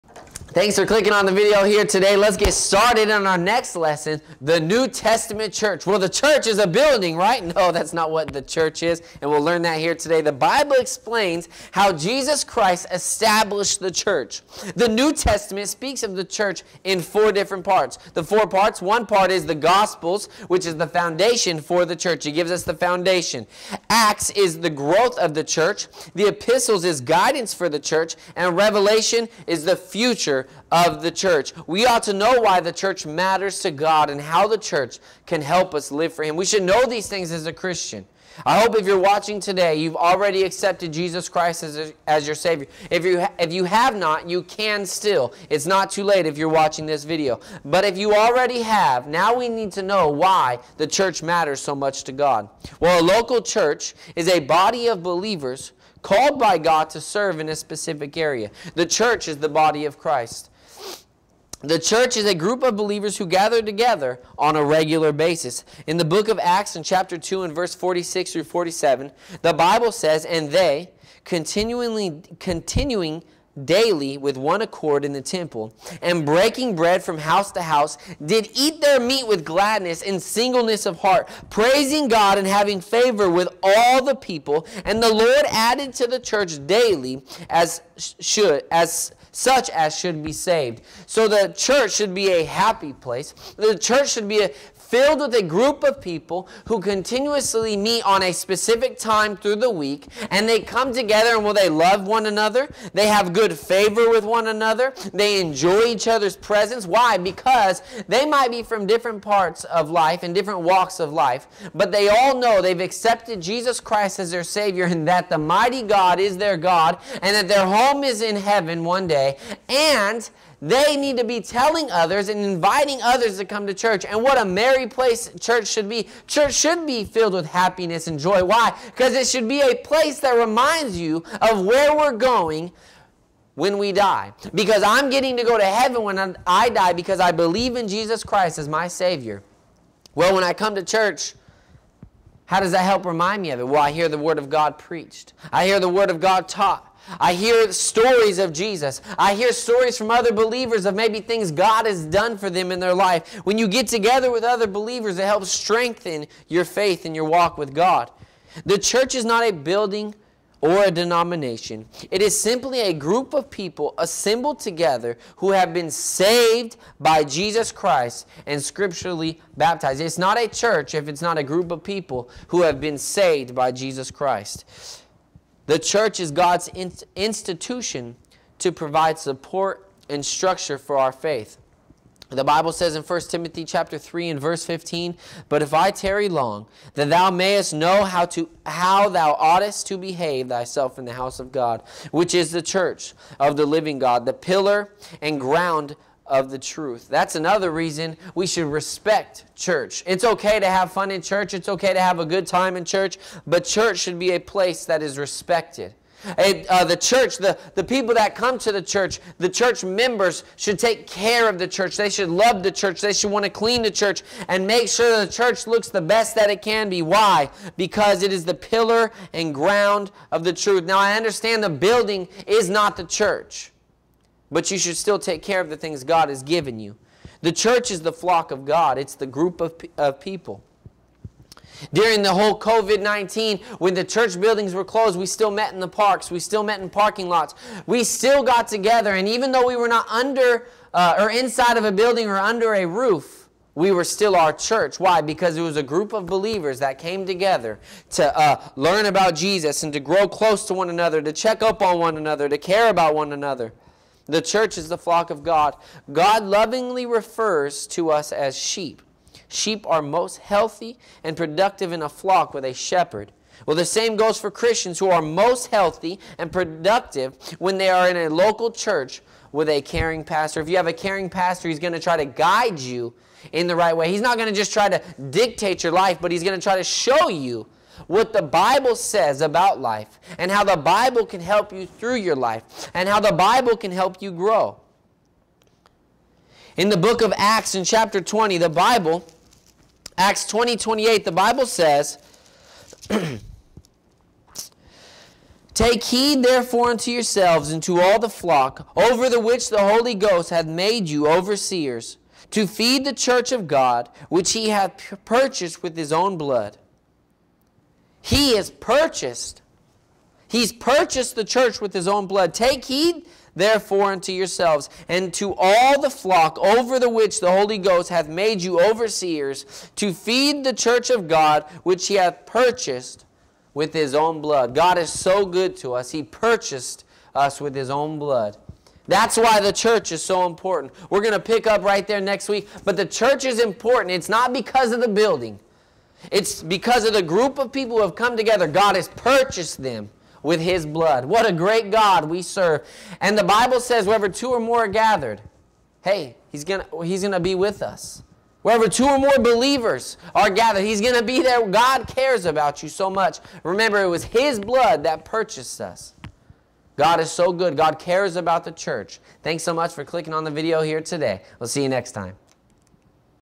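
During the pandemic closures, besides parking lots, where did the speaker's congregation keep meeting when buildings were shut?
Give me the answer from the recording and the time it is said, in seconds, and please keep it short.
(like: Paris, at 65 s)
Parks, at 235 s.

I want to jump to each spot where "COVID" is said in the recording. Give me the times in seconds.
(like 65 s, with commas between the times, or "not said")
232 s.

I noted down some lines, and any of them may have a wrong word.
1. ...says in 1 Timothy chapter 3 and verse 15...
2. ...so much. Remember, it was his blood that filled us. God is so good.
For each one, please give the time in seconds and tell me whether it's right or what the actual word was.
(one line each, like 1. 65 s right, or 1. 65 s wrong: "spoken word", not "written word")
1. 182 s right
2. 352 s wrong: "purchased", not "filled".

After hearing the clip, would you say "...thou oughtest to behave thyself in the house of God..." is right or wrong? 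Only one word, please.
right.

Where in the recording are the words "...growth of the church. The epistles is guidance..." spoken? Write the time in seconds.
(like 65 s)
24 s.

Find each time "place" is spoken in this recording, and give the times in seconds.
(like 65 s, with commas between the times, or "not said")
92 s, 124 s, 129 s, 204 s.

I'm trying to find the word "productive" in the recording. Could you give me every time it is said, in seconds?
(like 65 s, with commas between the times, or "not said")
261 s, 266 s.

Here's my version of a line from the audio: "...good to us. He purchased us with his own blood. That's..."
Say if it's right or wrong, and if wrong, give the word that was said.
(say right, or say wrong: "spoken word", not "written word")
right.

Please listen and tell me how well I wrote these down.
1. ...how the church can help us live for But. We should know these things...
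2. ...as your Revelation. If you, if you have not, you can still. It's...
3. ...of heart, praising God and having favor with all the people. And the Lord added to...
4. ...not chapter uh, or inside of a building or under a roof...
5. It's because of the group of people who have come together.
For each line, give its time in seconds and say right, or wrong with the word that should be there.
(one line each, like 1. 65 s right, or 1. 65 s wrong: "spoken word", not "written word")
1. 34 s wrong: "Him", not "But"
2. 42 s wrong: "Savior", not "Revelation"
3. 80 s right
4. 239 s wrong: "under", not "chapter"
5. 336 s right.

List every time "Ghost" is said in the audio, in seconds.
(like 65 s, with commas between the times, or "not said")
300 s, 317 s.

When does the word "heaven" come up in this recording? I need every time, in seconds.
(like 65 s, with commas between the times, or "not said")
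118 s, 135 s.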